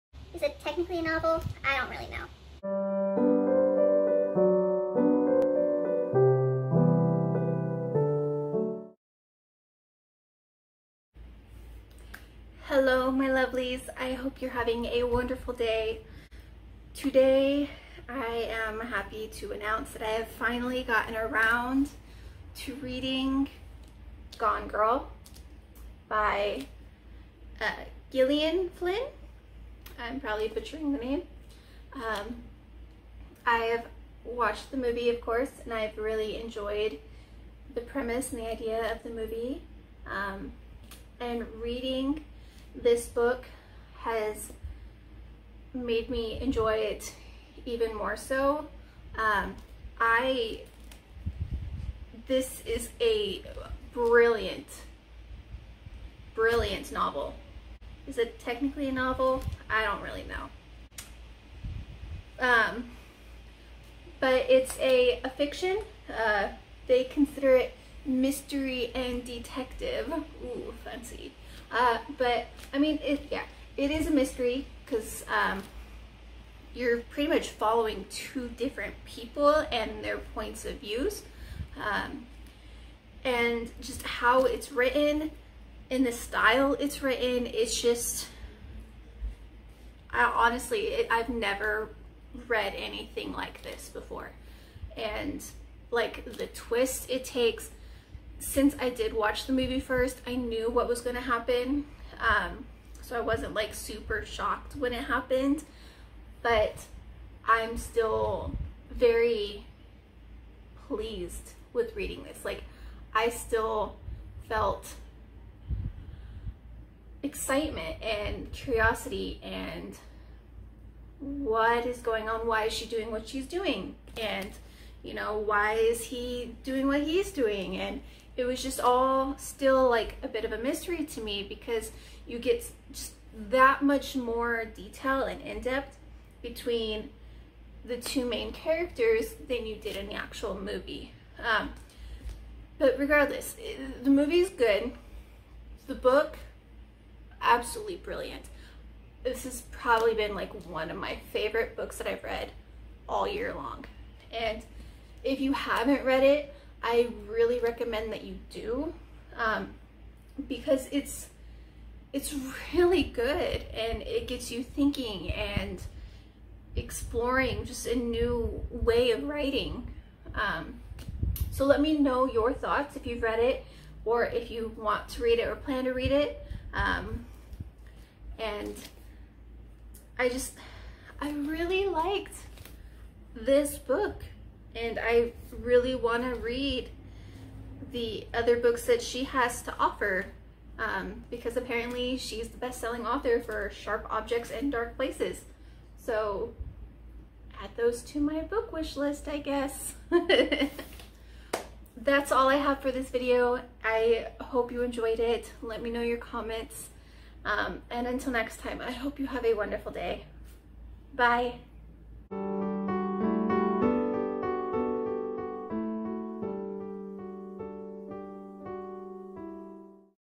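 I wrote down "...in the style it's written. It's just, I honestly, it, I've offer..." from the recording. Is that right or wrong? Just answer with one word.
wrong.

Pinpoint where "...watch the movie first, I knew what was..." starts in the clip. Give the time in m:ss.
1:39.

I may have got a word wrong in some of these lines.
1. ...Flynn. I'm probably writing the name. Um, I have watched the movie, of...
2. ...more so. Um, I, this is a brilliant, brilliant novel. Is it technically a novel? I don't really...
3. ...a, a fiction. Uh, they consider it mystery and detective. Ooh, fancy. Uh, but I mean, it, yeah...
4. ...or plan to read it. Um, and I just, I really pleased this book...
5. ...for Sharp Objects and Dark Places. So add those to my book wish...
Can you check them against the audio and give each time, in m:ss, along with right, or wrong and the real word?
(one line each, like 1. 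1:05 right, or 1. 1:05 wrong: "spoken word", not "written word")
1. 0:28 wrong: "butchering", not "writing"
2. 0:47 right
3. 1:04 right
4. 2:55 wrong: "liked", not "pleased"
5. 3:13 right.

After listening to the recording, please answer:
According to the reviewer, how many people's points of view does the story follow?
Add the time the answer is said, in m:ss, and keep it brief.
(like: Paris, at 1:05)
2, at 1:18.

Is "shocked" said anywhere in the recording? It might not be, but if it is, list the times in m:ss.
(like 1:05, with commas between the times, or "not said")
1:44.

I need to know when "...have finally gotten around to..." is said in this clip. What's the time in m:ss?
0:20.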